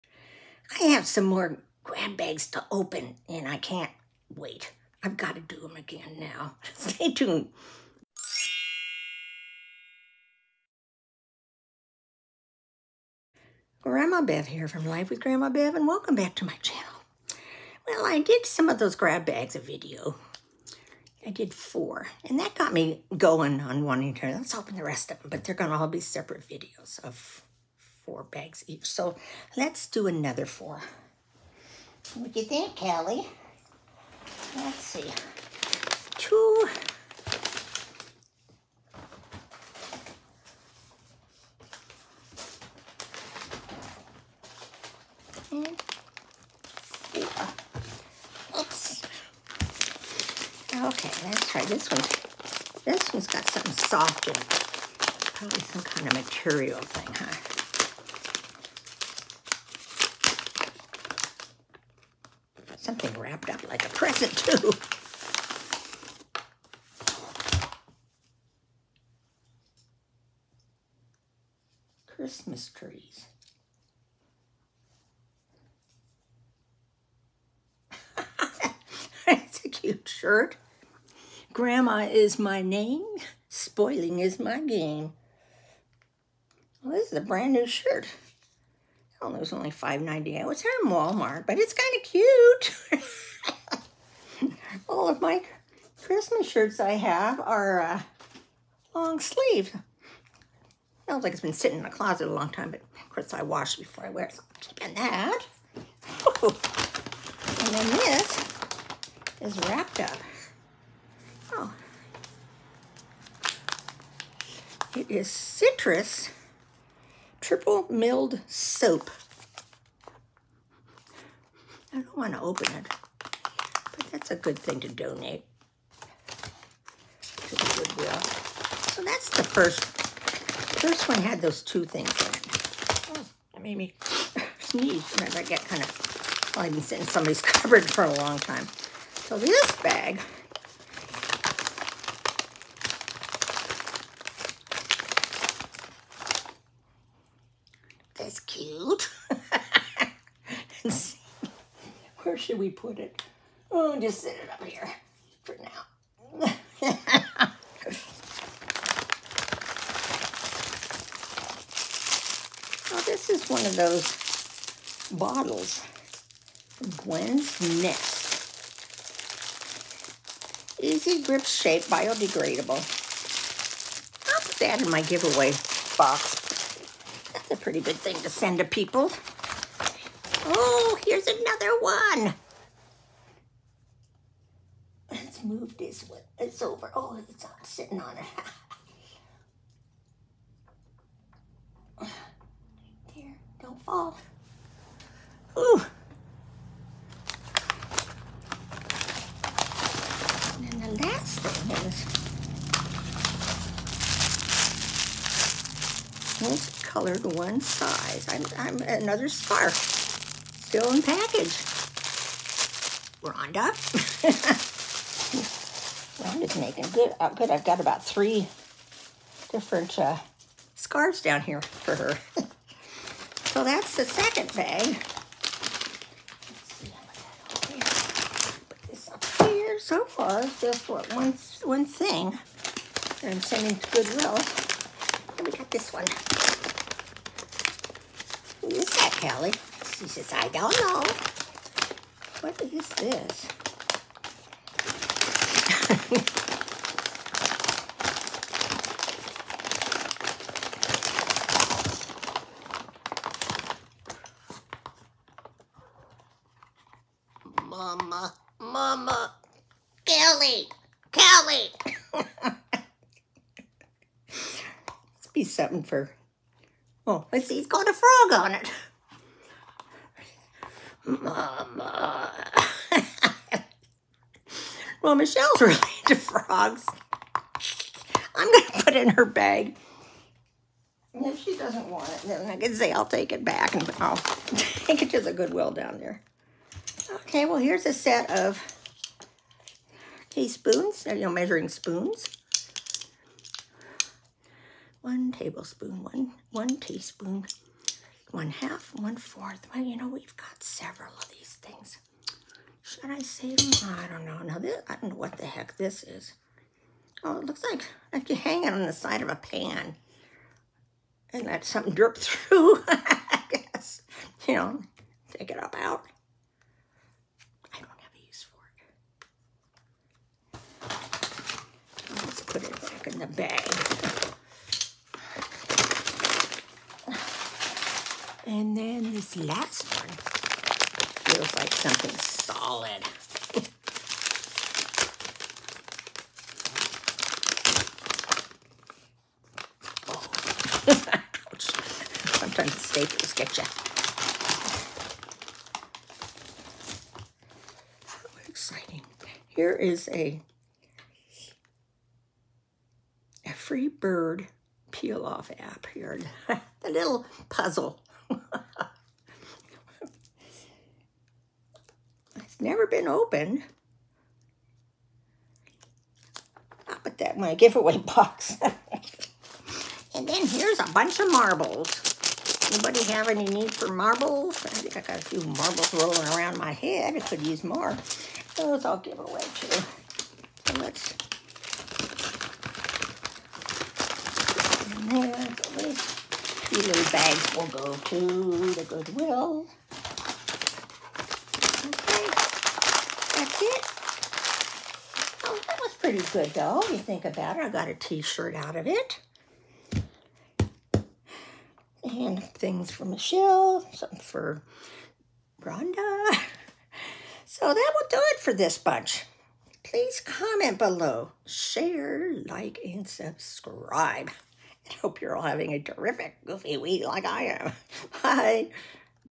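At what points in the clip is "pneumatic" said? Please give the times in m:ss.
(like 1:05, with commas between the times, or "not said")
not said.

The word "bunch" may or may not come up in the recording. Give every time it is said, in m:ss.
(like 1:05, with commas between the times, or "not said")
6:10, 6:48.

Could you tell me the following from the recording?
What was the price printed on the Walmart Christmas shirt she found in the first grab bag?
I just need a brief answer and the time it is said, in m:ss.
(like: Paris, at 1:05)
$5.98, at 1:29.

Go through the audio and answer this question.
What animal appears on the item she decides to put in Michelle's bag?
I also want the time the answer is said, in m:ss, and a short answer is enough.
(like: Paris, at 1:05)
A frog, at 4:27.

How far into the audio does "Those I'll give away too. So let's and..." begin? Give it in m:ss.
6:18.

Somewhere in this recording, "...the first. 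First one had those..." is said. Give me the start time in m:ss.
2:09.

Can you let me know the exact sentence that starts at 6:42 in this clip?
And things for Michelle, some for Rhonda.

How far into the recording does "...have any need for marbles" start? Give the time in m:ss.
6:13.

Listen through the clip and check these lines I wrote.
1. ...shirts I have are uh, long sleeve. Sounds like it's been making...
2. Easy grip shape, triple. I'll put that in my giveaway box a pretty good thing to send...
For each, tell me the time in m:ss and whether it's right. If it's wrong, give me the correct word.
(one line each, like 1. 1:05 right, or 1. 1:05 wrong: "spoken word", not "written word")
1. 1:36 wrong: "sitting", not "making"
2. 2:50 wrong: "biodegradable", not "triple".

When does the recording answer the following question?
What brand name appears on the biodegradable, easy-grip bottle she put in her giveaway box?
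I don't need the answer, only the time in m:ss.
2:46.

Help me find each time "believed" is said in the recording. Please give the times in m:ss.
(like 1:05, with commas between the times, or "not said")
not said.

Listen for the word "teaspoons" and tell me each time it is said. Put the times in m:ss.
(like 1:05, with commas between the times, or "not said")
4:50, 4:56.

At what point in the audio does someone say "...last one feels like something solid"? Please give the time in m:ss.
5:29.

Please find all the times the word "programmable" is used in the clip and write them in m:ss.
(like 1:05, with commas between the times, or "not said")
not said.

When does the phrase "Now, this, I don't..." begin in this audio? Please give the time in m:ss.
5:04.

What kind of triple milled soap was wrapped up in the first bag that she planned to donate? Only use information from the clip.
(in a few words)
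Citrus.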